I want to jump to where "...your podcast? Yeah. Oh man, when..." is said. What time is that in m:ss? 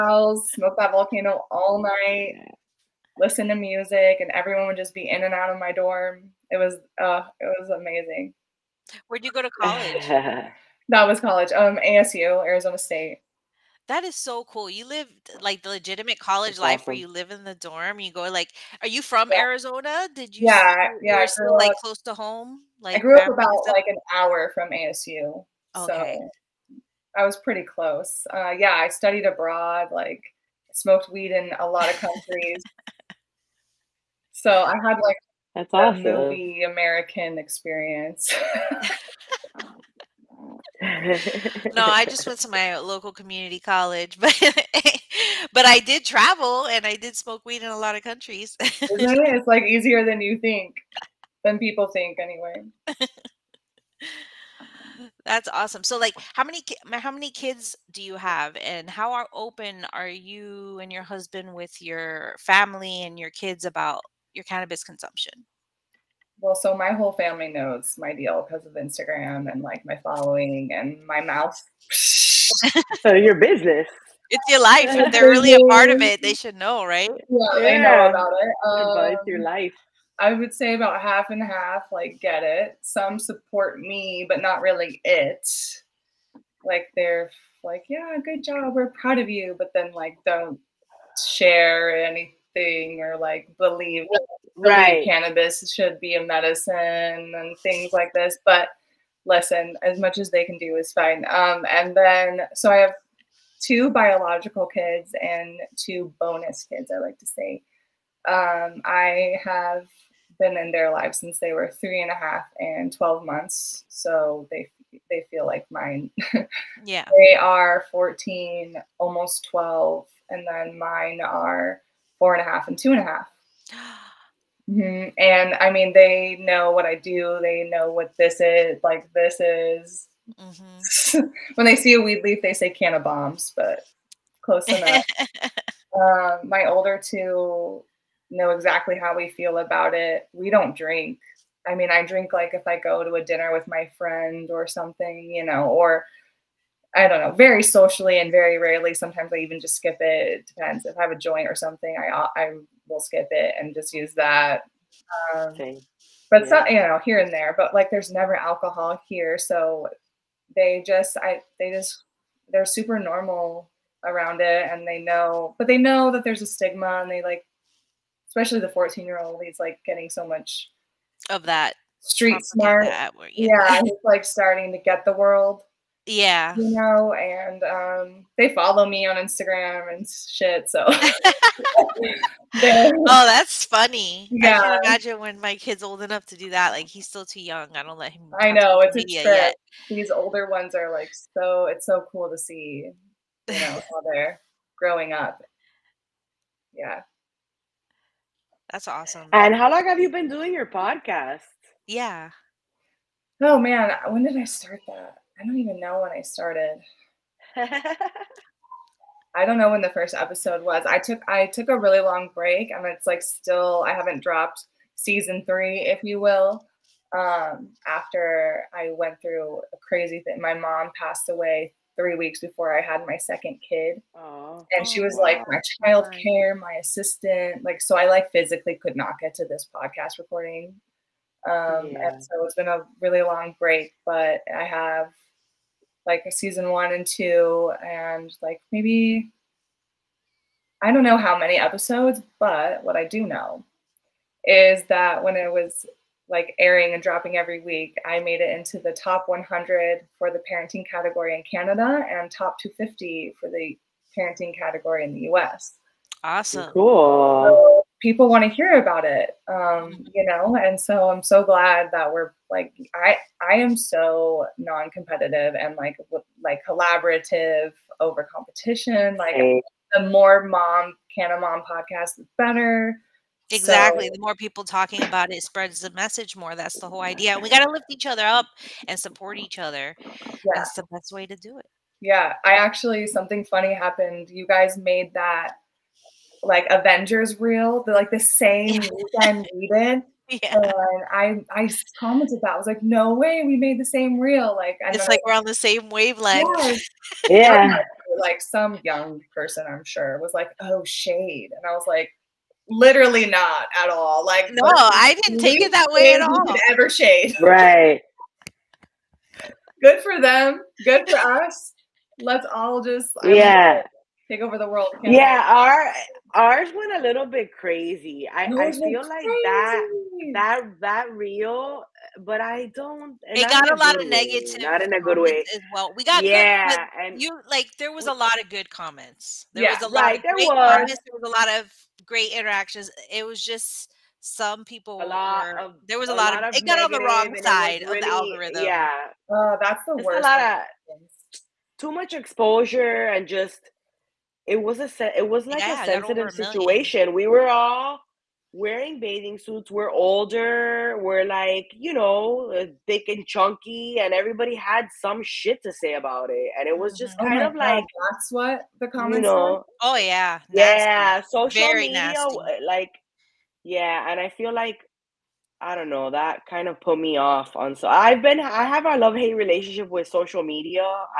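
3:20.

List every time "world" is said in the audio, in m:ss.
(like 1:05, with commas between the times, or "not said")
2:55, 5:14.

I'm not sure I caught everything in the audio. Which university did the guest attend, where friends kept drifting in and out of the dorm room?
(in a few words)
Arizona State.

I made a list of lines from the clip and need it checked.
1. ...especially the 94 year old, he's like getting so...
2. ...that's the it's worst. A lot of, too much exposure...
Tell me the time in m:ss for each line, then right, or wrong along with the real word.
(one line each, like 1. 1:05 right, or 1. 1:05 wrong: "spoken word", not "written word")
1. 2:48 wrong: "14", not "94"
2. 5:39 right.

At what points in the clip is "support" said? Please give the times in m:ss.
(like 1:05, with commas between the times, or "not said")
1:23, 4:38.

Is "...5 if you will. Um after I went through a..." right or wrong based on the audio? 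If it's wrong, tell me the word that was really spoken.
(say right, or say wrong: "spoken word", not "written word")
wrong: "3", not "5".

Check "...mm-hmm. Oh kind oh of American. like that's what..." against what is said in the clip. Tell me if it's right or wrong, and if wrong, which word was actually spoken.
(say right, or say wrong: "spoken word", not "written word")
wrong: "God", not "American".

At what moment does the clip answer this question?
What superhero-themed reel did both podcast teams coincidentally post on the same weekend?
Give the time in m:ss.
4:46.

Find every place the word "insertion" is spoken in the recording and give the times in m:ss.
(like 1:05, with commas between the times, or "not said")
not said.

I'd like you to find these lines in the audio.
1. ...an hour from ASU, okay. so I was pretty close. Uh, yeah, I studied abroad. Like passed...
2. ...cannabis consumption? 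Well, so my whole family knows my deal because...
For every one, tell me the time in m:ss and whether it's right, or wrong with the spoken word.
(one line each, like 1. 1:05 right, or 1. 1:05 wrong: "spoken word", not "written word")
1. 0:23 wrong: "smoked", not "passed"
2. 1:04 right.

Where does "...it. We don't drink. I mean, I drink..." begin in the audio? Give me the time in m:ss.
2:19.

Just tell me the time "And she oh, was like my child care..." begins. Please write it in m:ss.
3:44.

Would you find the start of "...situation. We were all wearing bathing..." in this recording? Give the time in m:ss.
5:46.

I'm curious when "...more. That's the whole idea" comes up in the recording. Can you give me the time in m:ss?
4:36.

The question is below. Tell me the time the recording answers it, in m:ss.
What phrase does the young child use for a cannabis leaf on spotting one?
2:12.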